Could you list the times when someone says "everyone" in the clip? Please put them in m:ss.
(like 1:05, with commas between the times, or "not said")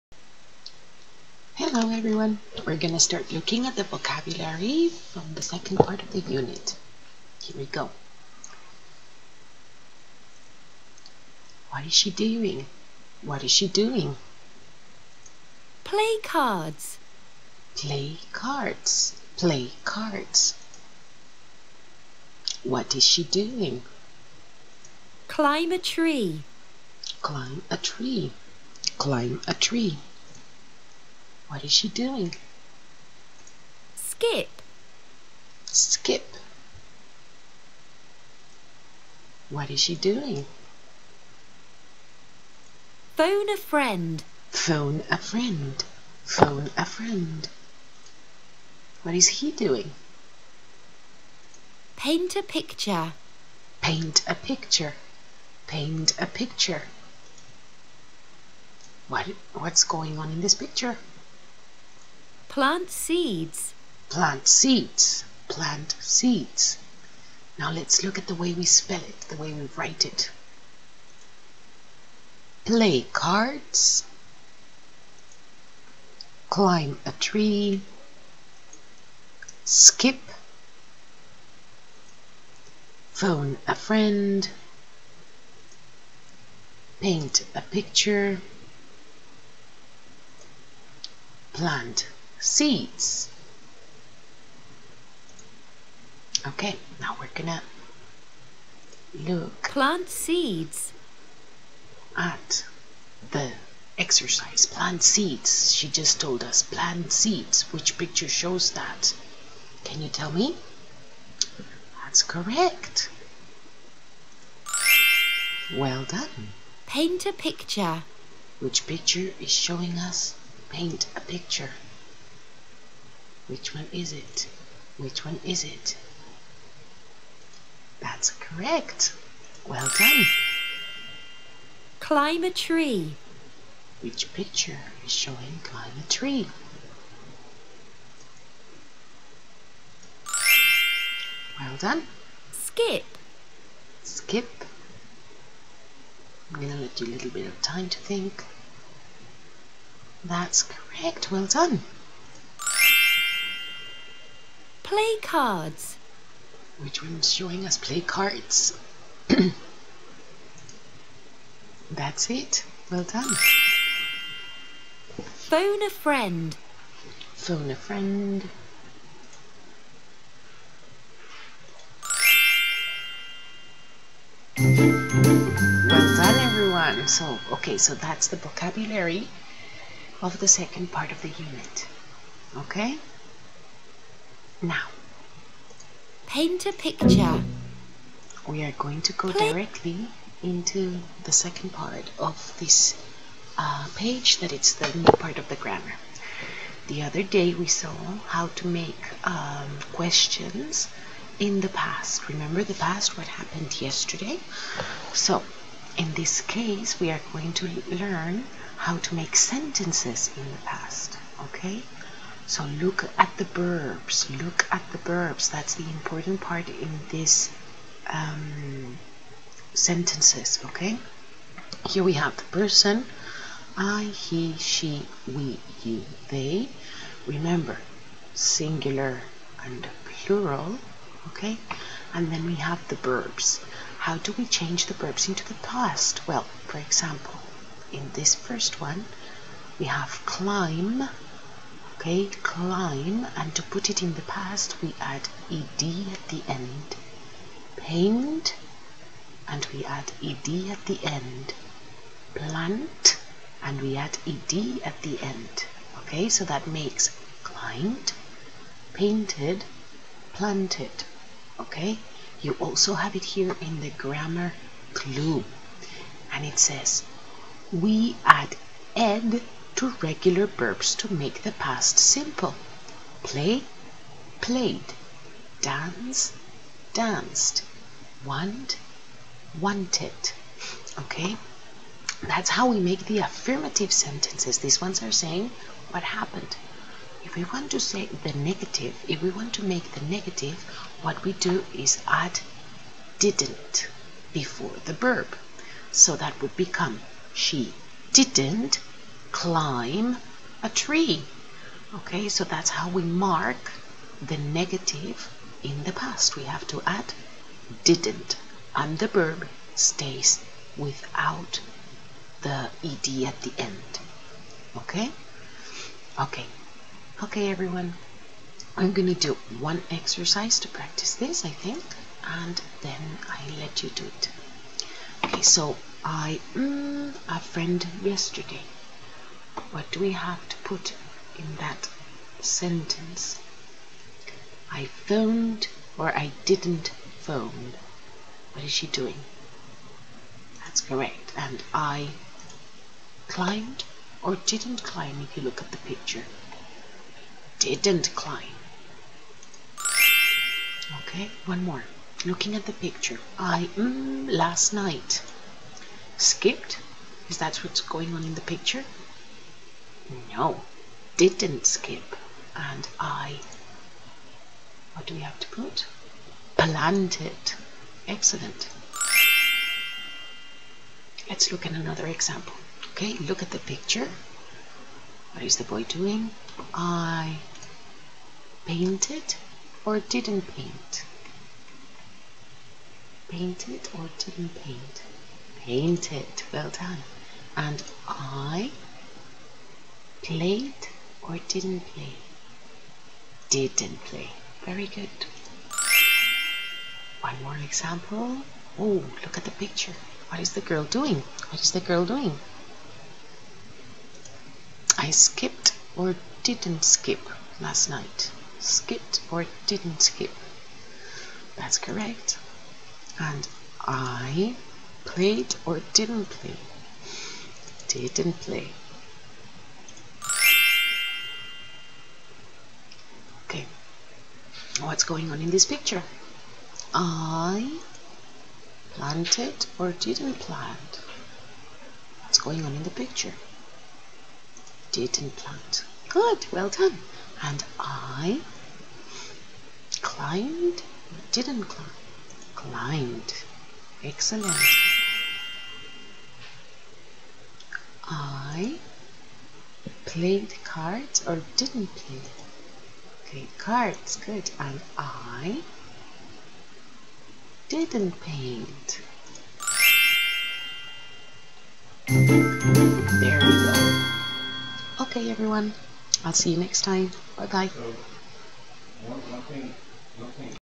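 0:01, 2:56, 5:17, 7:45.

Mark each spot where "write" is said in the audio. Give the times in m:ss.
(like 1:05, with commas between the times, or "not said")
1:09.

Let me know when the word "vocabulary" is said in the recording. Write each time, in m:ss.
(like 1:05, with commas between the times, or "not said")
0:03, 2:58.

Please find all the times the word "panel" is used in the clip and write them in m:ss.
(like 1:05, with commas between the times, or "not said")
not said.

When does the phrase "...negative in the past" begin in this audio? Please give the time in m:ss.
5:04.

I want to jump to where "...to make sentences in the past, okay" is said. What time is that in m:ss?
3:28.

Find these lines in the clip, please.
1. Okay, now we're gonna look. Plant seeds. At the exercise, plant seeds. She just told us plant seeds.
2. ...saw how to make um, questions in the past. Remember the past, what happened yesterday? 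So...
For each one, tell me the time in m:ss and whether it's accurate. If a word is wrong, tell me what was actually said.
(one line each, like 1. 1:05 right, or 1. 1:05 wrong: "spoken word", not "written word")
1. 1:36 right
2. 3:17 right.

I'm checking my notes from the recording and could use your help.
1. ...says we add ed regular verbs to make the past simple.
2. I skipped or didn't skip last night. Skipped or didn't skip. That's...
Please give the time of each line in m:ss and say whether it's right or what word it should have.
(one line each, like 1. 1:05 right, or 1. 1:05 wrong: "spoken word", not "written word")
1. 4:26 right
2. 6:44 right.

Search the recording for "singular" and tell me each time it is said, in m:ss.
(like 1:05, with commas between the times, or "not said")
3:48.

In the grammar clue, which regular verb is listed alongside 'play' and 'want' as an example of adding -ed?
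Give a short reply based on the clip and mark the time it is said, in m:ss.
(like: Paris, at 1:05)
Dance, at 4:35.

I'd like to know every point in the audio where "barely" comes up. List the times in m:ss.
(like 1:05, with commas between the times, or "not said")
not said.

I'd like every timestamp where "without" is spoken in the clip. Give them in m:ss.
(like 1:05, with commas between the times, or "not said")
5:10.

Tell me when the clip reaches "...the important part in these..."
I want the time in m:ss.
3:35.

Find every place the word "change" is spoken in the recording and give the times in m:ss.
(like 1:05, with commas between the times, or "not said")
3:54.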